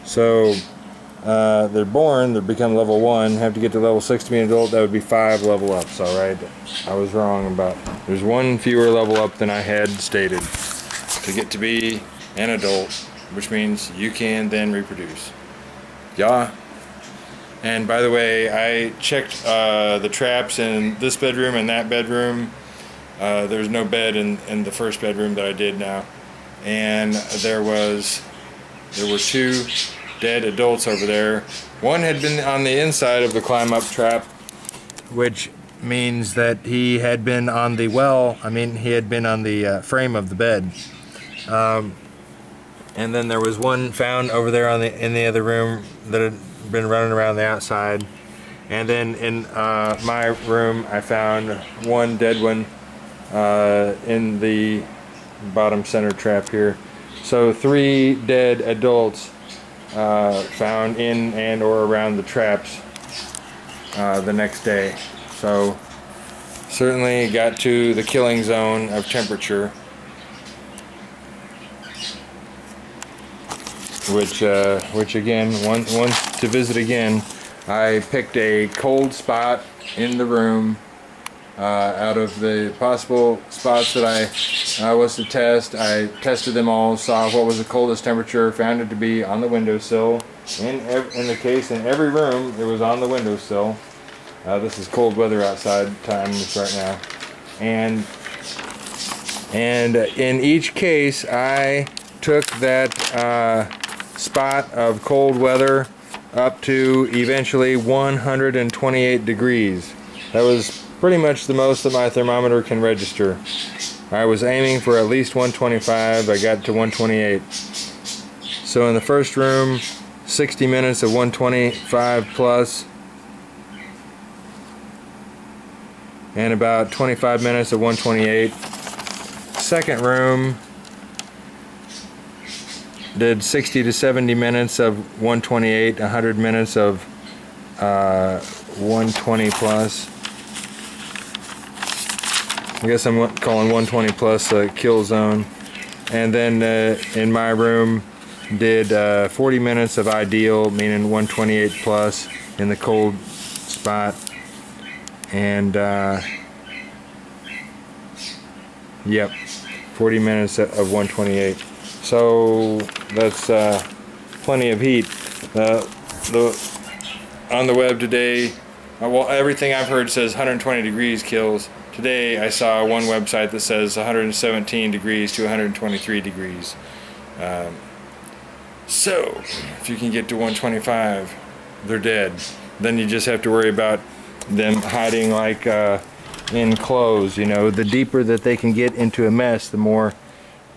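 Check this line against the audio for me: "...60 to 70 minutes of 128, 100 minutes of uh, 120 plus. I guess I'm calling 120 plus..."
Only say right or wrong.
right.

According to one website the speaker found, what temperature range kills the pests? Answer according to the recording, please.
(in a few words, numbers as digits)
117 to 123 degrees.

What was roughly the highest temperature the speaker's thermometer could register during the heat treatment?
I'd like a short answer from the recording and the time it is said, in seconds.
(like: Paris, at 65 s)
128 degrees, at 107 s.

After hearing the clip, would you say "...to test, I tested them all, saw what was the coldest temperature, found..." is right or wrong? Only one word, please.
right.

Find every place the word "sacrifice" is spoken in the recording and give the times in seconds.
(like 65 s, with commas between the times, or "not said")
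not said.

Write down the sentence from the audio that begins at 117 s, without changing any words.
So in the first room, 60 minutes of 125 plus, and about 25 minutes of 128.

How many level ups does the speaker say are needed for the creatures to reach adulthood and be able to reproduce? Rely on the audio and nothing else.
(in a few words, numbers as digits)
5.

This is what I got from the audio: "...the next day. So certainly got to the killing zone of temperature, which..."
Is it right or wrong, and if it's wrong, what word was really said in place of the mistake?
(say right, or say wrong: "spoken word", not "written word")
right.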